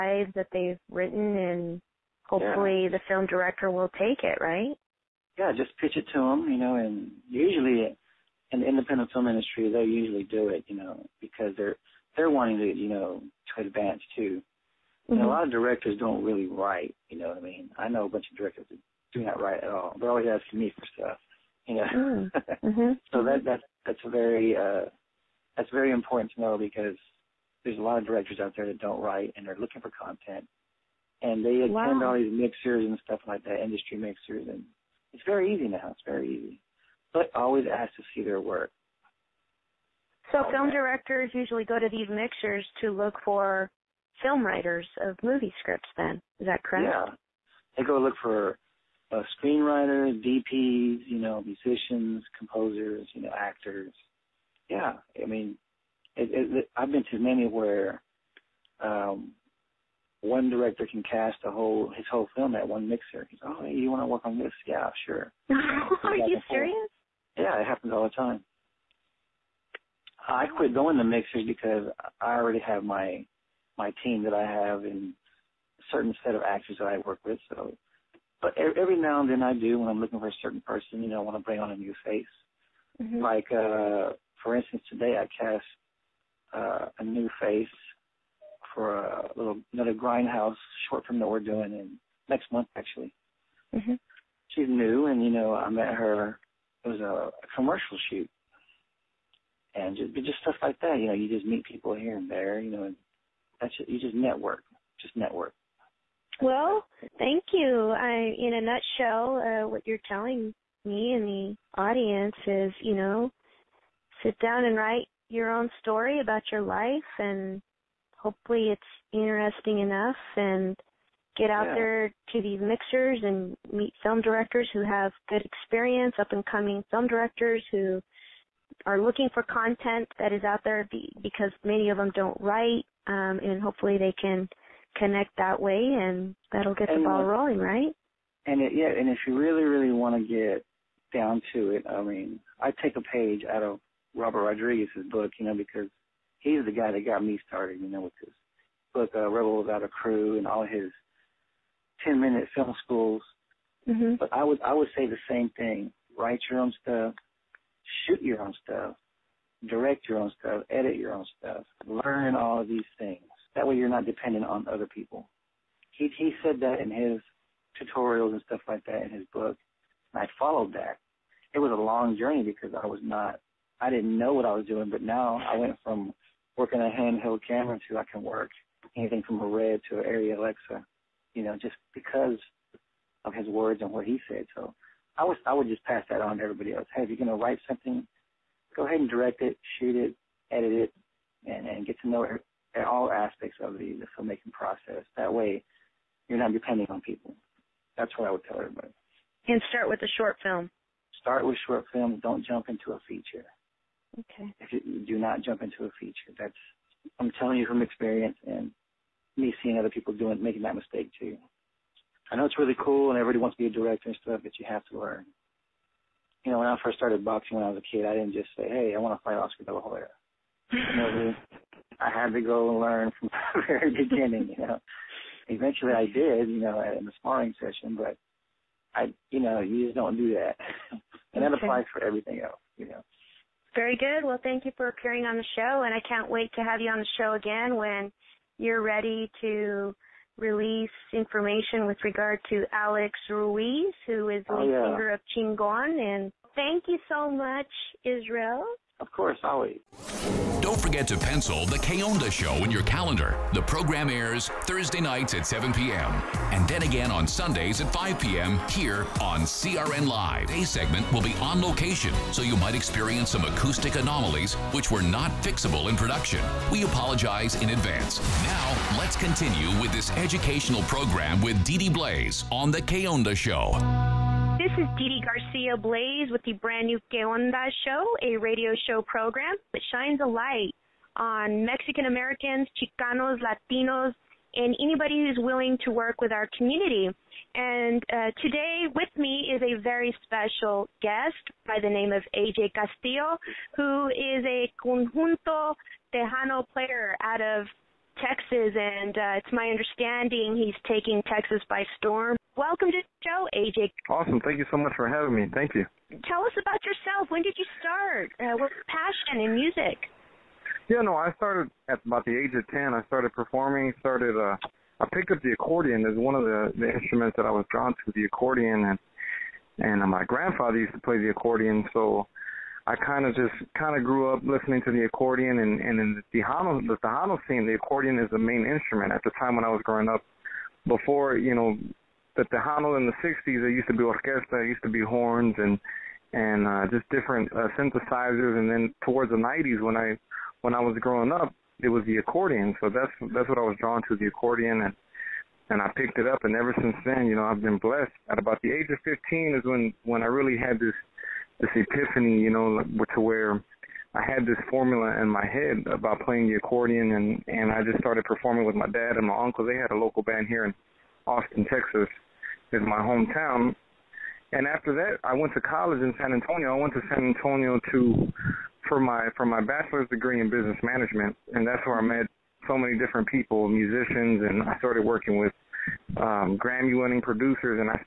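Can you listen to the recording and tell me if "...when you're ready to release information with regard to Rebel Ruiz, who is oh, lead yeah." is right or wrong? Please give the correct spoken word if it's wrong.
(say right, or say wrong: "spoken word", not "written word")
wrong: "Alex", not "Rebel".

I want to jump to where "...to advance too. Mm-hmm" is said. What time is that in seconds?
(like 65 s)
13 s.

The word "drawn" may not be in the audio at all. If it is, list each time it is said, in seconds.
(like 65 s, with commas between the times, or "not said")
317 s, 343 s.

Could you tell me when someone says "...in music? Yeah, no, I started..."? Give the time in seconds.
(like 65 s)
309 s.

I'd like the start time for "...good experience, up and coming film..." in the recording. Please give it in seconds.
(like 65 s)
125 s.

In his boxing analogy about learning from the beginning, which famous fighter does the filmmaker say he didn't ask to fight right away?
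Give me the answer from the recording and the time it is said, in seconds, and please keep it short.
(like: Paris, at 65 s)
Oscar De La Hoya, at 219 s.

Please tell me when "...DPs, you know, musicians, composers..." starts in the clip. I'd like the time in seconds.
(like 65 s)
50 s.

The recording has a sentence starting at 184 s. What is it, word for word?
So I was I would just pass that on to everybody else.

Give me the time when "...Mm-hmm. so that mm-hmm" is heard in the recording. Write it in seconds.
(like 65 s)
22 s.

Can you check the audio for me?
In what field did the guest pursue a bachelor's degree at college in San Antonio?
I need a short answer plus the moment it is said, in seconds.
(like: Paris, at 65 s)
Business management, at 370 s.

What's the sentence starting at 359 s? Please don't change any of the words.
They had a local band here in Austin, Texas, is my hometown.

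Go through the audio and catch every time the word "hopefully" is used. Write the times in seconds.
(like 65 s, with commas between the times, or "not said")
2 s, 118 s, 133 s.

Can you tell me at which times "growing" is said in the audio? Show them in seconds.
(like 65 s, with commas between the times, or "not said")
329 s, 340 s.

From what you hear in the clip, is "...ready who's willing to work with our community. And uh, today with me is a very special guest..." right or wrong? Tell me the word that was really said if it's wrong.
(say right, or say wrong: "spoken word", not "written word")
wrong: "anybody", not "ready".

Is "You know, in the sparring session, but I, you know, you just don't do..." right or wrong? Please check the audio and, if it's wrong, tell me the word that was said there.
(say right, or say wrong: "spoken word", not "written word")
right.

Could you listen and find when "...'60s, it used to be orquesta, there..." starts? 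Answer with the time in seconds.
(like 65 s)
333 s.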